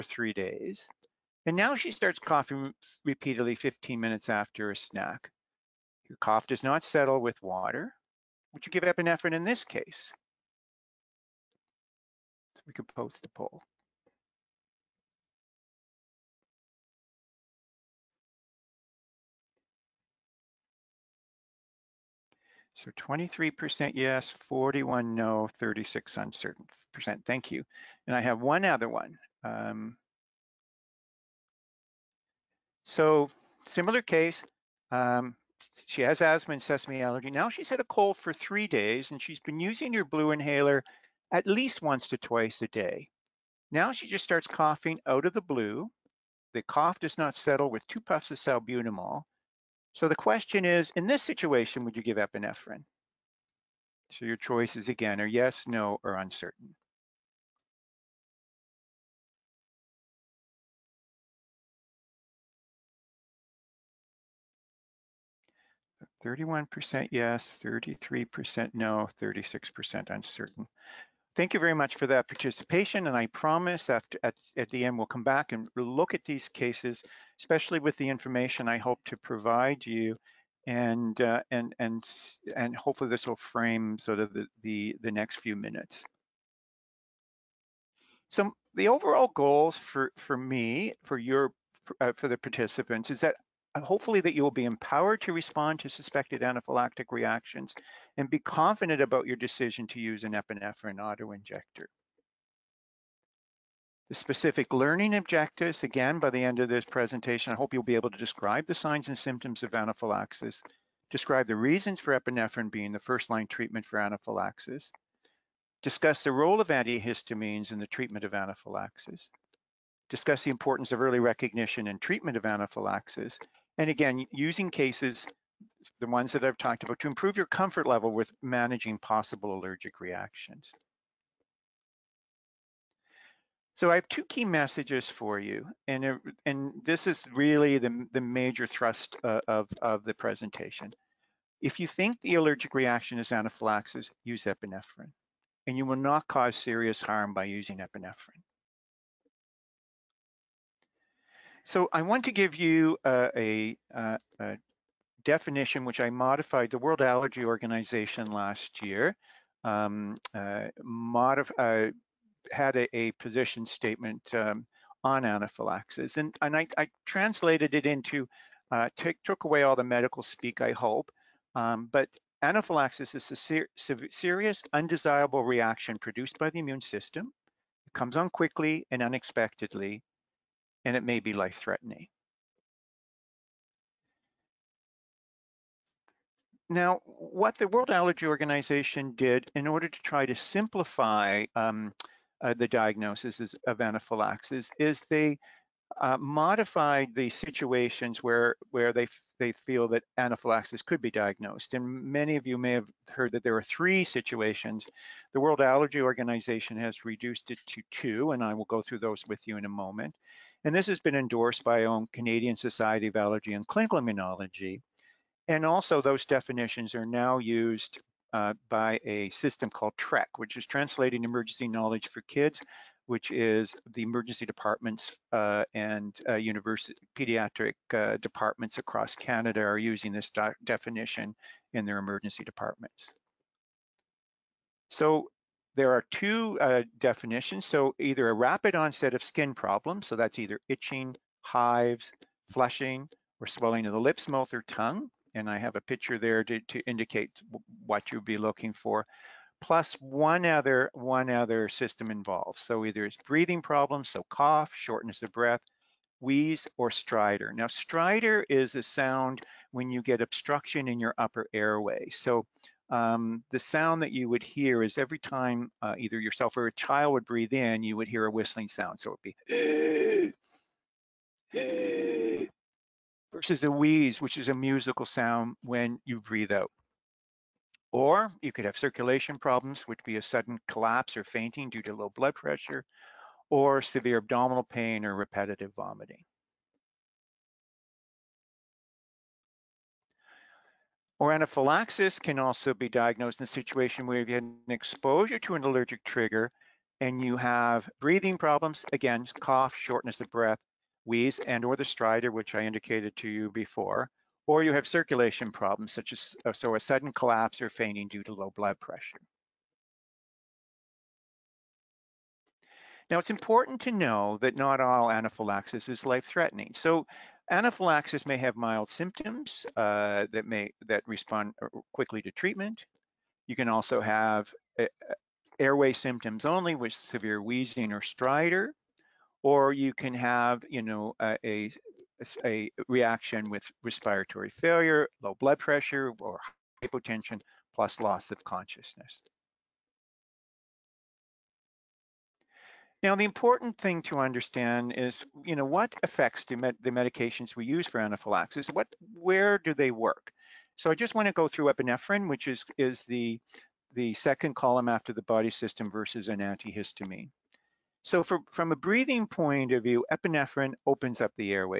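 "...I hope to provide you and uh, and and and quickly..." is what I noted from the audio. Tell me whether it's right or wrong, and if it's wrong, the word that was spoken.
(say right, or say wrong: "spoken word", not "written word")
wrong: "hopefully", not "quickly".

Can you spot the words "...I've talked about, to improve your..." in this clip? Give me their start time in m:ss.
2:06.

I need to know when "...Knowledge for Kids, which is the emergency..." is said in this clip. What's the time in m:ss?
3:41.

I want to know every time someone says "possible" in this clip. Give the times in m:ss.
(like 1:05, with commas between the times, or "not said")
2:08.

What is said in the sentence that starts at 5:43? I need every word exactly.
Now, the important thing to understand is, you know, what affects the, med the medications we use for anaphylaxis?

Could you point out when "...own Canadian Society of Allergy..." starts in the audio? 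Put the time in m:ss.
3:31.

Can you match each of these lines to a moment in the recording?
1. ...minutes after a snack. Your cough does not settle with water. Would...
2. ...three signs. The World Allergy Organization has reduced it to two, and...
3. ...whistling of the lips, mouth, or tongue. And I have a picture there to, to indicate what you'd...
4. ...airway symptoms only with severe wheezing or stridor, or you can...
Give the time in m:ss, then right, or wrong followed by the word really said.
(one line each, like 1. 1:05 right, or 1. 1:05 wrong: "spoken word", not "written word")
1. 0:03 right
2. 3:23 wrong: "situations", not "signs"
3. 4:03 wrong: "swelling", not "whistling"
4. 5:25 right.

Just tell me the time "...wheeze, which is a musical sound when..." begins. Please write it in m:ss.
4:33.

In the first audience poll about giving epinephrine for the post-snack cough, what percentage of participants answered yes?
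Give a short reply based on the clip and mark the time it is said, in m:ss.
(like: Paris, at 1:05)
23%, at 0:22.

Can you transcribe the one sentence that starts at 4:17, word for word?
Now, stridor is a sound when you get obstruction in your upper airway.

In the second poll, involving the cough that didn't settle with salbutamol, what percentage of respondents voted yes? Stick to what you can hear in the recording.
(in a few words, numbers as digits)
31%.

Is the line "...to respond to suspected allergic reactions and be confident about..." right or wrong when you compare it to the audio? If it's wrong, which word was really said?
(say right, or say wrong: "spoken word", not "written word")
wrong: "anaphylactic", not "allergic".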